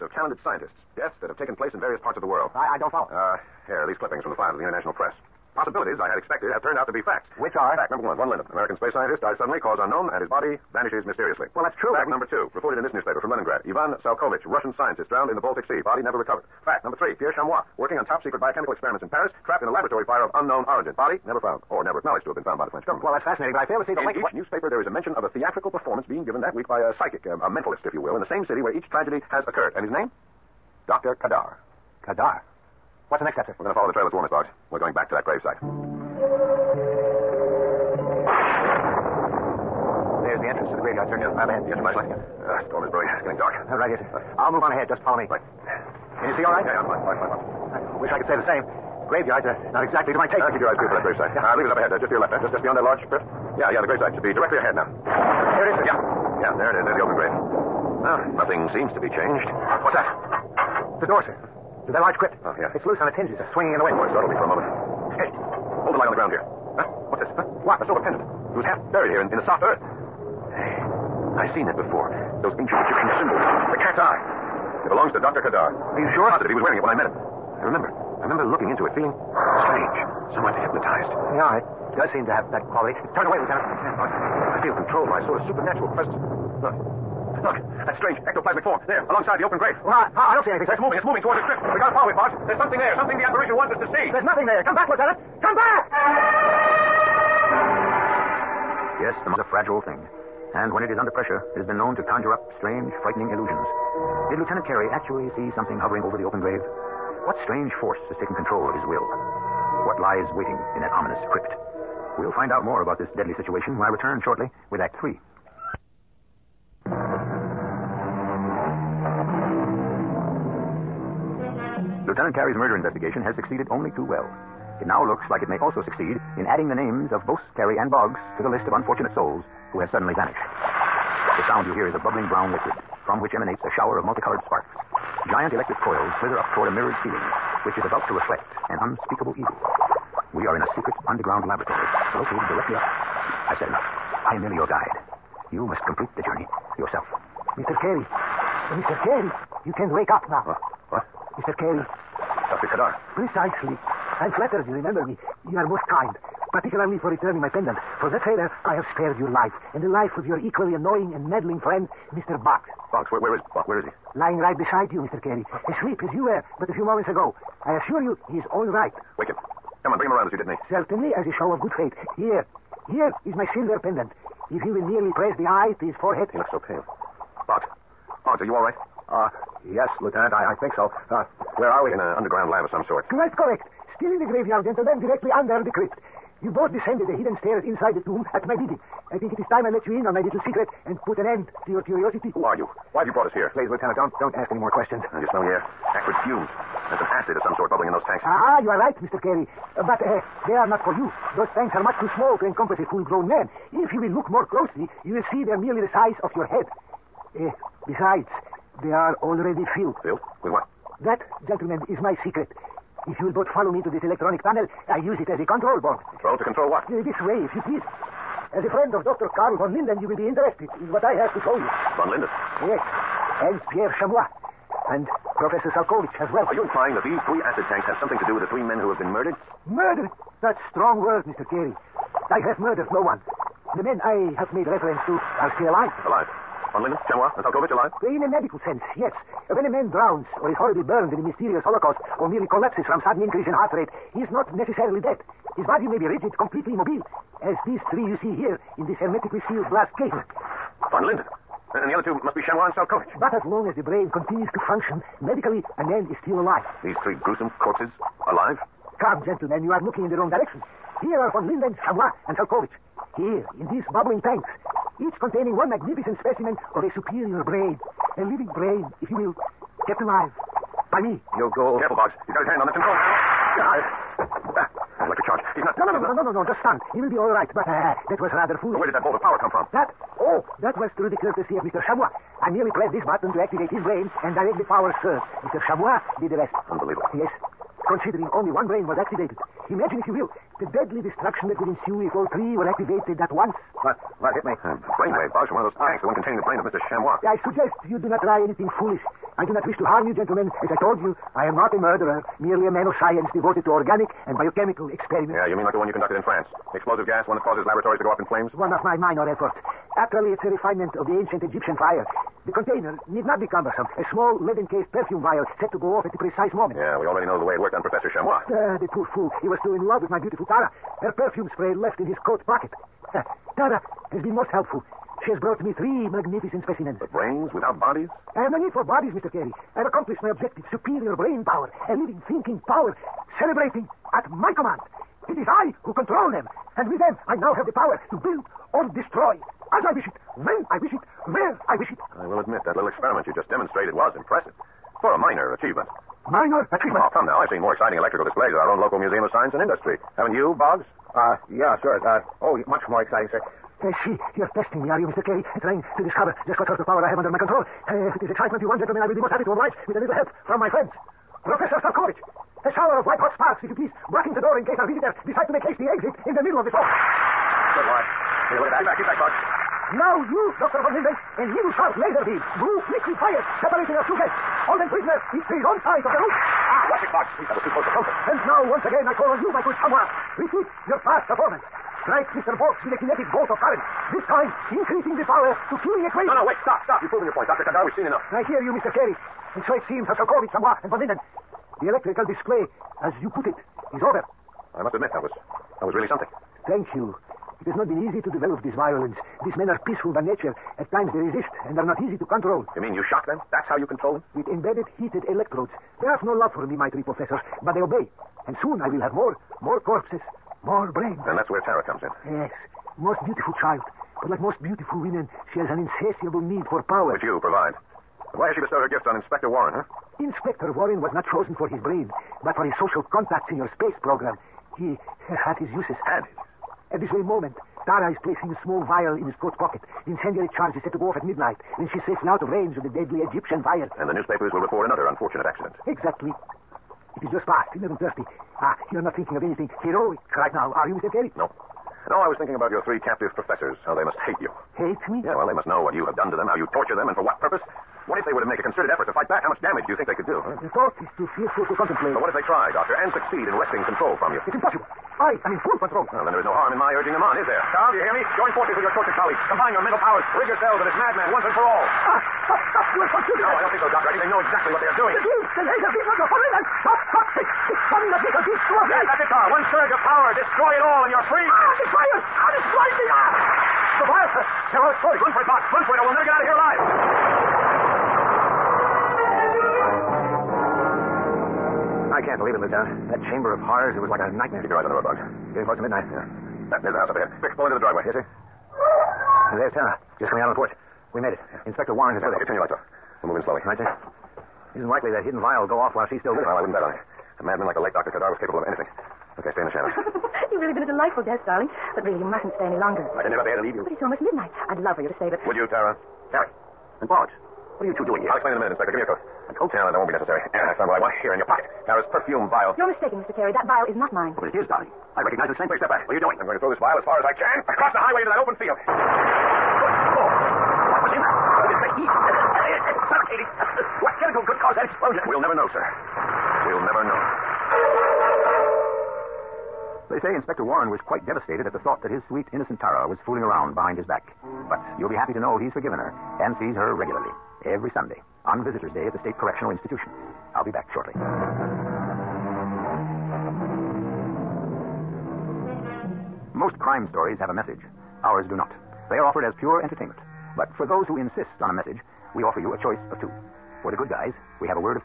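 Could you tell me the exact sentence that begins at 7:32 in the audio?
But what if they try, Doctor, and succeed in wresting control from you?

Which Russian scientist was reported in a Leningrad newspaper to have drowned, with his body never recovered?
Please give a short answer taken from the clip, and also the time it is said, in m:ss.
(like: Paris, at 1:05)
Ivan Salkovich, at 0:13.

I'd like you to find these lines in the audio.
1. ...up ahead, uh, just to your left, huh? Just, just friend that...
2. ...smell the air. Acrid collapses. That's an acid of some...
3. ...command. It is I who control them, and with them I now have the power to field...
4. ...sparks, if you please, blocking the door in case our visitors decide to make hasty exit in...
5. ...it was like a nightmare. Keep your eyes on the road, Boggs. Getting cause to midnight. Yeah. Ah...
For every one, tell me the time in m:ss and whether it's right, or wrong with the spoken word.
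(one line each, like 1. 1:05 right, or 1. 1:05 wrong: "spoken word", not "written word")
1. 0:51 wrong: "beyond", not "friend"
2. 3:15 wrong: "fumes", not "collapses"
3. 5:34 wrong: "build", not "field"
4. 6:03 right
5. 8:03 wrong: "close", not "cause".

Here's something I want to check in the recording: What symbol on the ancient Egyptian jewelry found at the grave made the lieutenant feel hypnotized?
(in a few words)
The cat's eye.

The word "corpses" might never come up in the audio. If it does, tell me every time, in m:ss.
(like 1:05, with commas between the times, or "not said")
4:17, 6:49.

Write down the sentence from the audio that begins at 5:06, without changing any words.
The explosive gas, one that causes laboratories to go up in flames?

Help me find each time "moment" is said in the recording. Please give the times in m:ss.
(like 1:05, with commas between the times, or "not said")
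1:04, 2:46, 5:16, 7:07.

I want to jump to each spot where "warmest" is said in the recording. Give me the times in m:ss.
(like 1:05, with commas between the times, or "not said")
0:34.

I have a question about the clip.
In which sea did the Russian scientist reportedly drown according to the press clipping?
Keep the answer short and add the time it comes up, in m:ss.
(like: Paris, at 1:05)
Baltic Sea, at 0:15.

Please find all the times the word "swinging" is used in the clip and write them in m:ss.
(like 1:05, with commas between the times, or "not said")
1:03.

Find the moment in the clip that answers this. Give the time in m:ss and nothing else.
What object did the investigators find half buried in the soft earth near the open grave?
1:07.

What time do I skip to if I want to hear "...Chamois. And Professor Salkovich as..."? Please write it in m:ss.
3:44.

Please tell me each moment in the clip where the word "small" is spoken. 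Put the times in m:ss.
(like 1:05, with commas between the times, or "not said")
3:22, 5:14, 7:08.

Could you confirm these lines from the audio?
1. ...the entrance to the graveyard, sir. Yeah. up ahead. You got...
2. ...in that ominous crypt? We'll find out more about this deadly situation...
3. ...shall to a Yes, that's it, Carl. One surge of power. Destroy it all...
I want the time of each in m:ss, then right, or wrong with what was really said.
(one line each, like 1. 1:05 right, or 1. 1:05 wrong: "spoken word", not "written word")
1. 0:40 right
2. 1:50 right
3. 7:48 right.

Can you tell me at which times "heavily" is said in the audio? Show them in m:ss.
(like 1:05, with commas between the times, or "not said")
not said.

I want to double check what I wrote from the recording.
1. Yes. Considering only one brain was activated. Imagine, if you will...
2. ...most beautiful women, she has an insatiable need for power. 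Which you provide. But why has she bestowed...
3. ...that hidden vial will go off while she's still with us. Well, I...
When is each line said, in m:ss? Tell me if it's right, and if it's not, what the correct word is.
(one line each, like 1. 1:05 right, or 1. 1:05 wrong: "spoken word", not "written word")
1. 4:47 right
2. 6:54 right
3. 8:15 right.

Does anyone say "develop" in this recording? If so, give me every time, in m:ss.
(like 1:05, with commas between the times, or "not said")
6:38.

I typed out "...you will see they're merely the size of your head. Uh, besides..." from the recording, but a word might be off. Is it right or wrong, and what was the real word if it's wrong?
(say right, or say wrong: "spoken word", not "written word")
right.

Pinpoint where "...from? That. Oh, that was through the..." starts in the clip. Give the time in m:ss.
4:39.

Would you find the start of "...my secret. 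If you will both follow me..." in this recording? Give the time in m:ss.
3:32.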